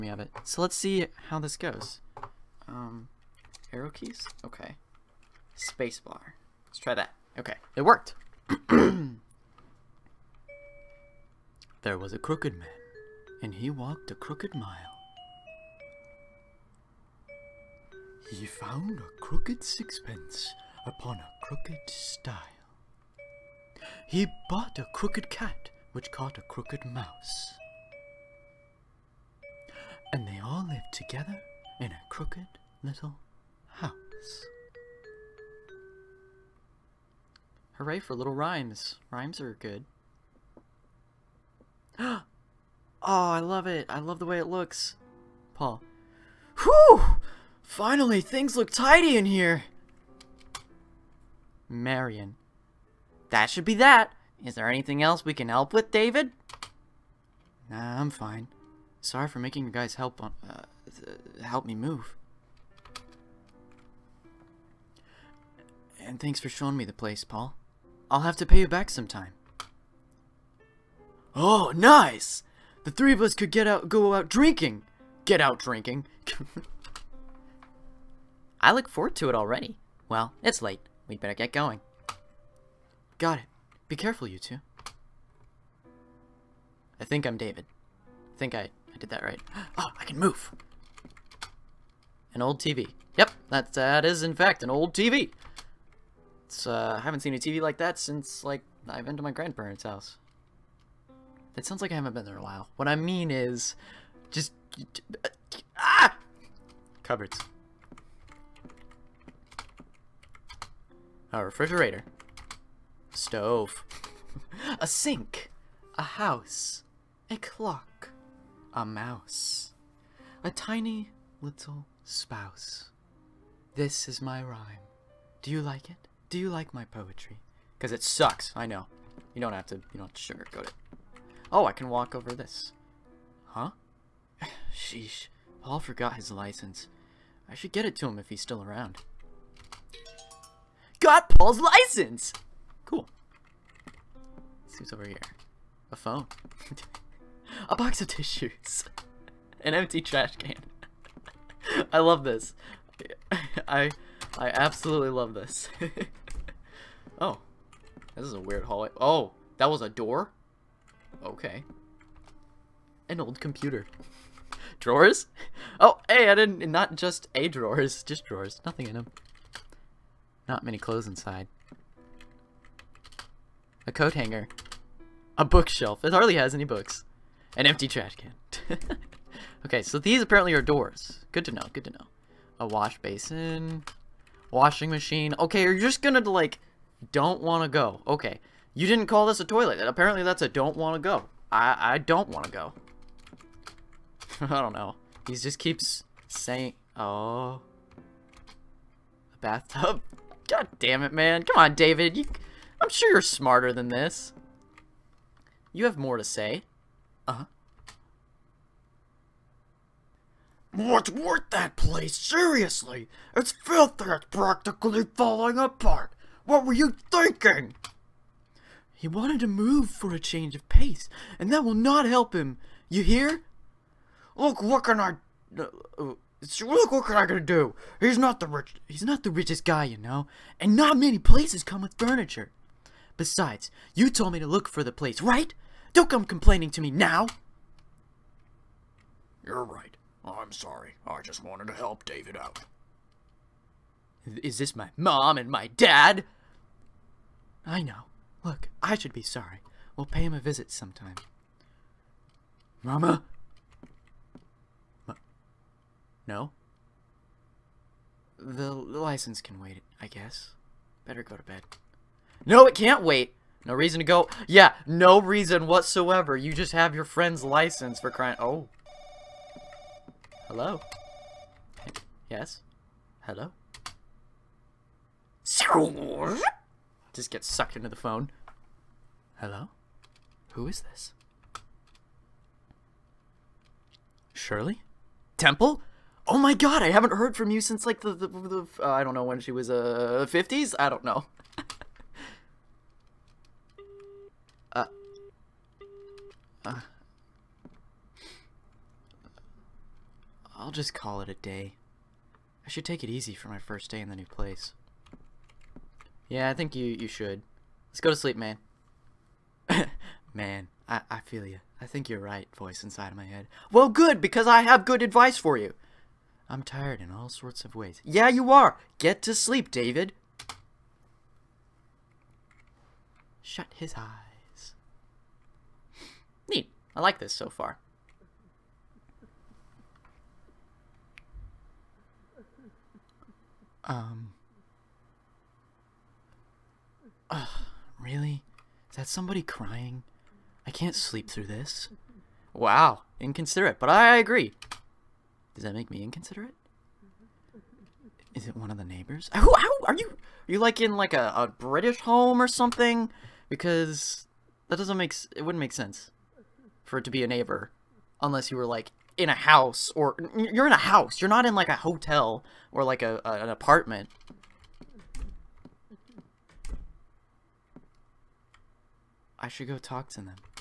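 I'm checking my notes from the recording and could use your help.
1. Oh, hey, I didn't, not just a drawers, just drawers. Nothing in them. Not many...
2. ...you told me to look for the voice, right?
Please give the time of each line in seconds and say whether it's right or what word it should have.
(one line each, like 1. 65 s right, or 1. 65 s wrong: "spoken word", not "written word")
1. 165 s right
2. 233 s wrong: "place", not "voice".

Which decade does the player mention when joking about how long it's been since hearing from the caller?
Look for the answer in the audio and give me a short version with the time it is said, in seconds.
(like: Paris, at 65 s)
The 50s, at 290 s.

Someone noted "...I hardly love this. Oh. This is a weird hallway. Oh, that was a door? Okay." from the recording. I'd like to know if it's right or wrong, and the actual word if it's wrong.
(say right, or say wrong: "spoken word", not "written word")
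wrong: "absolutely", not "hardly".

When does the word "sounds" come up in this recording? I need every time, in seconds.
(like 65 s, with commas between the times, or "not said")
101 s.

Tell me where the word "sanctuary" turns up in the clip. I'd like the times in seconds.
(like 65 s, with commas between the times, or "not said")
not said.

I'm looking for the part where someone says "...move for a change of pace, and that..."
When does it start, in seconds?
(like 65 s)
219 s.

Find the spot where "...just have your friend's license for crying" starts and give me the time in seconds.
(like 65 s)
266 s.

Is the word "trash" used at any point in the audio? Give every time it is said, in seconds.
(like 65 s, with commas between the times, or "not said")
150 s, 177 s.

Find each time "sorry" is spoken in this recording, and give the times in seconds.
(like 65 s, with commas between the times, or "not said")
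59 s, 240 s, 249 s.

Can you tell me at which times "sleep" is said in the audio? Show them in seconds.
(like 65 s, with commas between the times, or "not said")
308 s, 319 s, 340 s.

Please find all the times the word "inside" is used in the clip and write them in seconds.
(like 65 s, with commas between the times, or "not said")
171 s, 312 s.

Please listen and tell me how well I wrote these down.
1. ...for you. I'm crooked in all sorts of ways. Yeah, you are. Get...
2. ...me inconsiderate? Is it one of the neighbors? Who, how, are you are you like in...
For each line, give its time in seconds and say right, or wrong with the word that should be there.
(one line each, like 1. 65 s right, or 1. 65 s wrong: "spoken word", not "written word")
1. 315 s wrong: "tired", not "crooked"
2. 345 s right.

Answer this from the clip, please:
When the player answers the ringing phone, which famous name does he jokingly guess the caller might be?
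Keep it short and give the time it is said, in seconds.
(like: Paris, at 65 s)
Shirley Temple, at 284 s.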